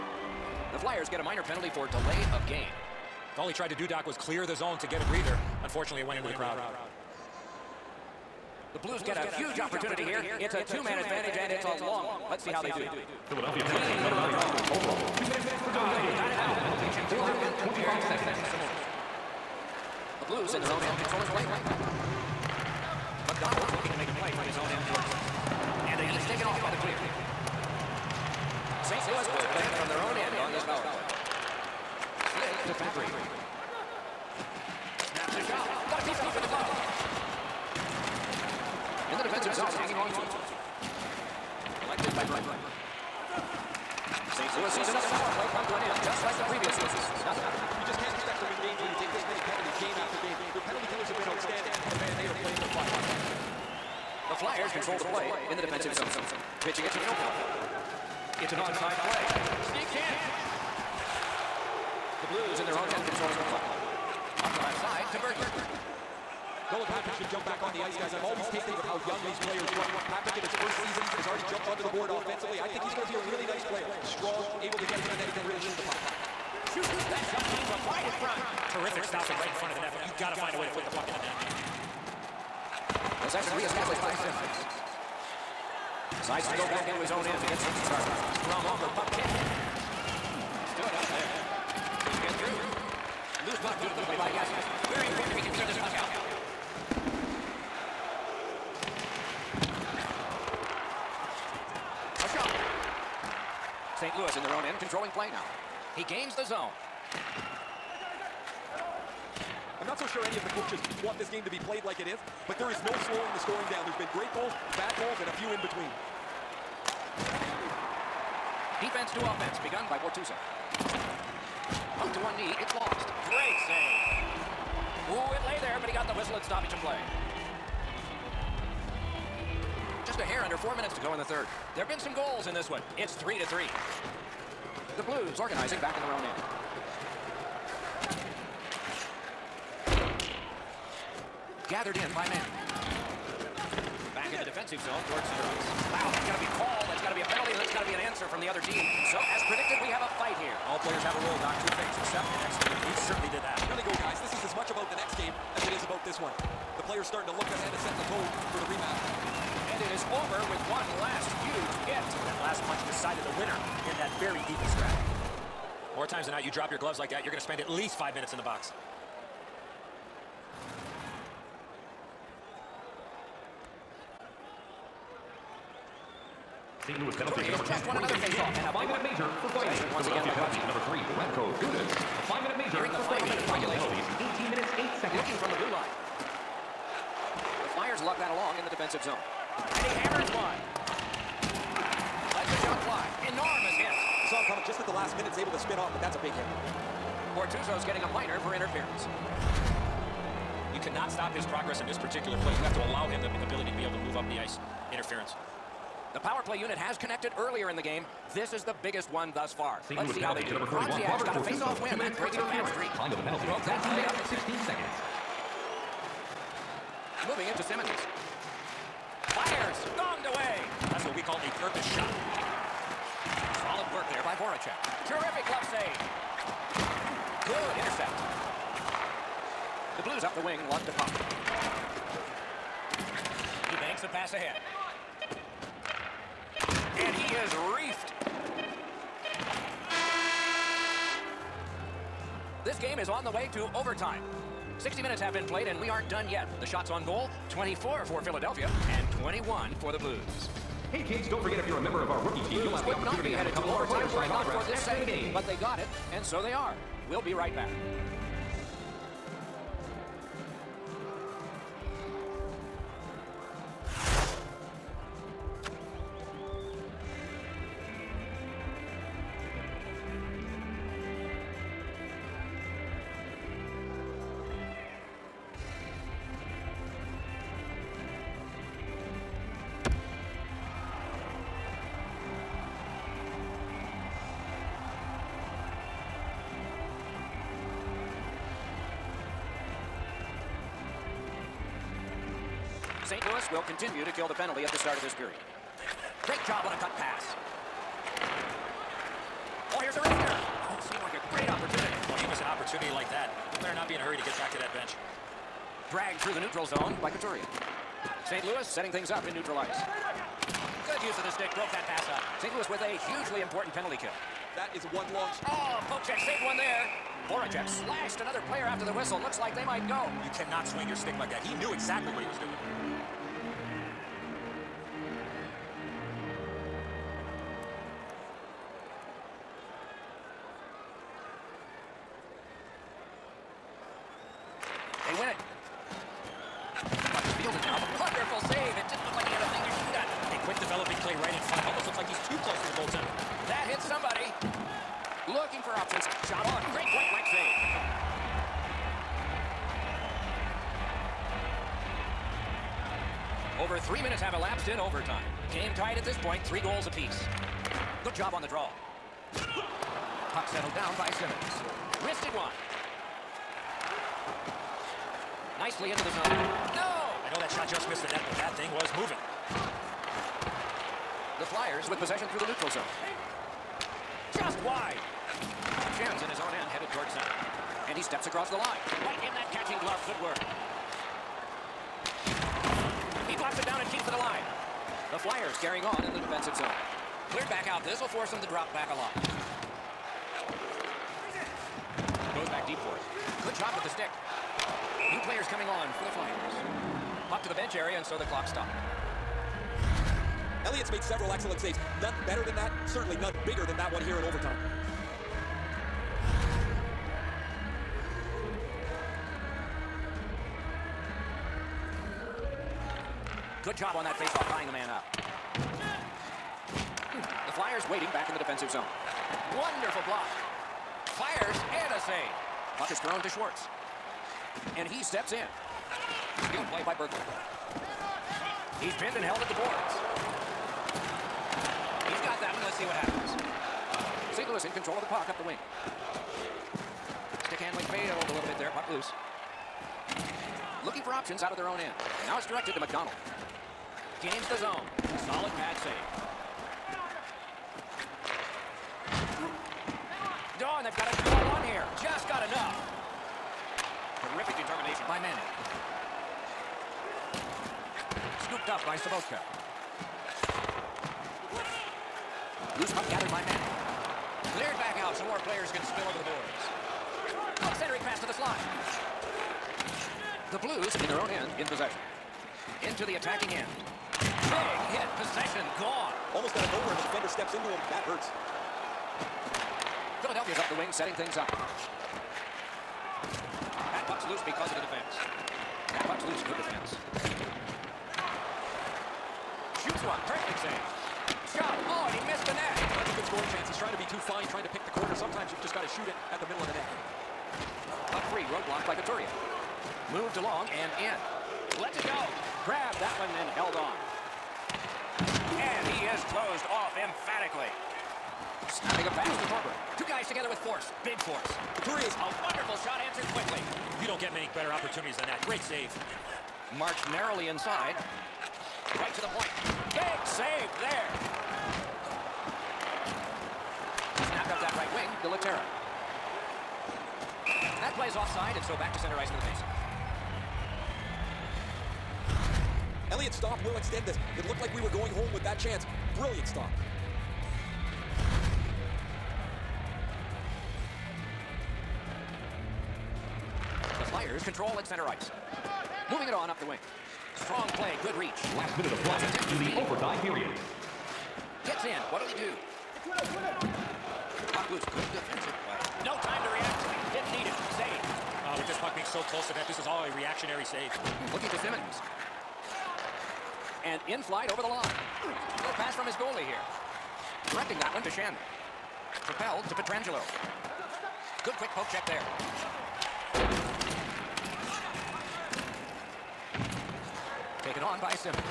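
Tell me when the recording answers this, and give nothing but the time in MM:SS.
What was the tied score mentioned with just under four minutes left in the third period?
02:13.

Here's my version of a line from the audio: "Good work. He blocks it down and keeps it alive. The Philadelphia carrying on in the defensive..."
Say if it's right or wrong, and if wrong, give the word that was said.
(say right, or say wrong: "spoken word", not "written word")
wrong: "Flyers", not "Philadelphia".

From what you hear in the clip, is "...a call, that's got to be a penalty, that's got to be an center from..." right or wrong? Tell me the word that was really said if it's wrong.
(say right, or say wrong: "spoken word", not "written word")
wrong: "answer", not "center".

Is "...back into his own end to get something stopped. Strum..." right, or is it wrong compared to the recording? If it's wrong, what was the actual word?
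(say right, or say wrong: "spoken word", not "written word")
wrong: "started", not "stopped".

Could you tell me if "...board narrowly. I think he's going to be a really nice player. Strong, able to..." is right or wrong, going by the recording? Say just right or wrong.
wrong.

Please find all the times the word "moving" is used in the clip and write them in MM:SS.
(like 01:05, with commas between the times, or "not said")
03:37, 06:08, 09:06.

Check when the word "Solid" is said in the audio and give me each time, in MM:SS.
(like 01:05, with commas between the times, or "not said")
03:43, 07:25.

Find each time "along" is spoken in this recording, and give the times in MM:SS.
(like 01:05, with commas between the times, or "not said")
03:08, 08:20.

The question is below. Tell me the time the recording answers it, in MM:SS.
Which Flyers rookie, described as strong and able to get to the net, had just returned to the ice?
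01:06.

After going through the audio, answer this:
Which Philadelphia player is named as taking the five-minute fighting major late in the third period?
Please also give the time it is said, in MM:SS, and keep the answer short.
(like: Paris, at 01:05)
Radko Gudas, at 03:01.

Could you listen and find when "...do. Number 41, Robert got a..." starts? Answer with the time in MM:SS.
03:30.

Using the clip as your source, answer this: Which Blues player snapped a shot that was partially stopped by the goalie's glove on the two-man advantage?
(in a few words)
Fabbri.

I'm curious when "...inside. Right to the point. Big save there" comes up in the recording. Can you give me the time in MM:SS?
08:37.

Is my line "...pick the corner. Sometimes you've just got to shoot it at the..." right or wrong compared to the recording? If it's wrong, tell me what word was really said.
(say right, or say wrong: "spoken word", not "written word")
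right.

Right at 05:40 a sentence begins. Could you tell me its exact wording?
A quick developing play right in front.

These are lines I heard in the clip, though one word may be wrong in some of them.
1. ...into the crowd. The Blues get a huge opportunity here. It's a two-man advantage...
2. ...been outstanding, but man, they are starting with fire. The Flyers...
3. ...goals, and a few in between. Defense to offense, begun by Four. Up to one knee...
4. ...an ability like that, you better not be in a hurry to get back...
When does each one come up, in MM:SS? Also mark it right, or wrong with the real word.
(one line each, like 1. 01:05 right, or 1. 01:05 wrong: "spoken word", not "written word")
1. 00:06 right
2. 00:51 wrong: "playing", not "starting"
3. 01:54 wrong: "Bortuzzo", not "Four"
4. 05:02 wrong: "opportunity", not "ability".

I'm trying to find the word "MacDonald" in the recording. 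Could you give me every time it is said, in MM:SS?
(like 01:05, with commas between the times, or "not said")
00:23, 07:22.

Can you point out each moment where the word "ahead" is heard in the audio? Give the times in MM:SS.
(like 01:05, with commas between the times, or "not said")
02:37, 03:54.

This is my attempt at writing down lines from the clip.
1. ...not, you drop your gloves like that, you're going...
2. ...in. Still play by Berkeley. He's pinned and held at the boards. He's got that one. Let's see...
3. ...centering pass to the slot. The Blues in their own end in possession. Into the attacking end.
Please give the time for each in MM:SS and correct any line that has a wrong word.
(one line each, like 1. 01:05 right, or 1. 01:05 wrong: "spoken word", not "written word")
1. 02:46 right
2. 07:05 right
3. 07:47 right.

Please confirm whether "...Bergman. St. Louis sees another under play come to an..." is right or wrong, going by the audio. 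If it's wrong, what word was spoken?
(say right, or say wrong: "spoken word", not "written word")
wrong: "power", not "under".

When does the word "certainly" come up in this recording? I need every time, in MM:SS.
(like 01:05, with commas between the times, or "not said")
02:33, 06:42.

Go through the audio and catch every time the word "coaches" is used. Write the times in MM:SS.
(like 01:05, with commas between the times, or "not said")
01:50.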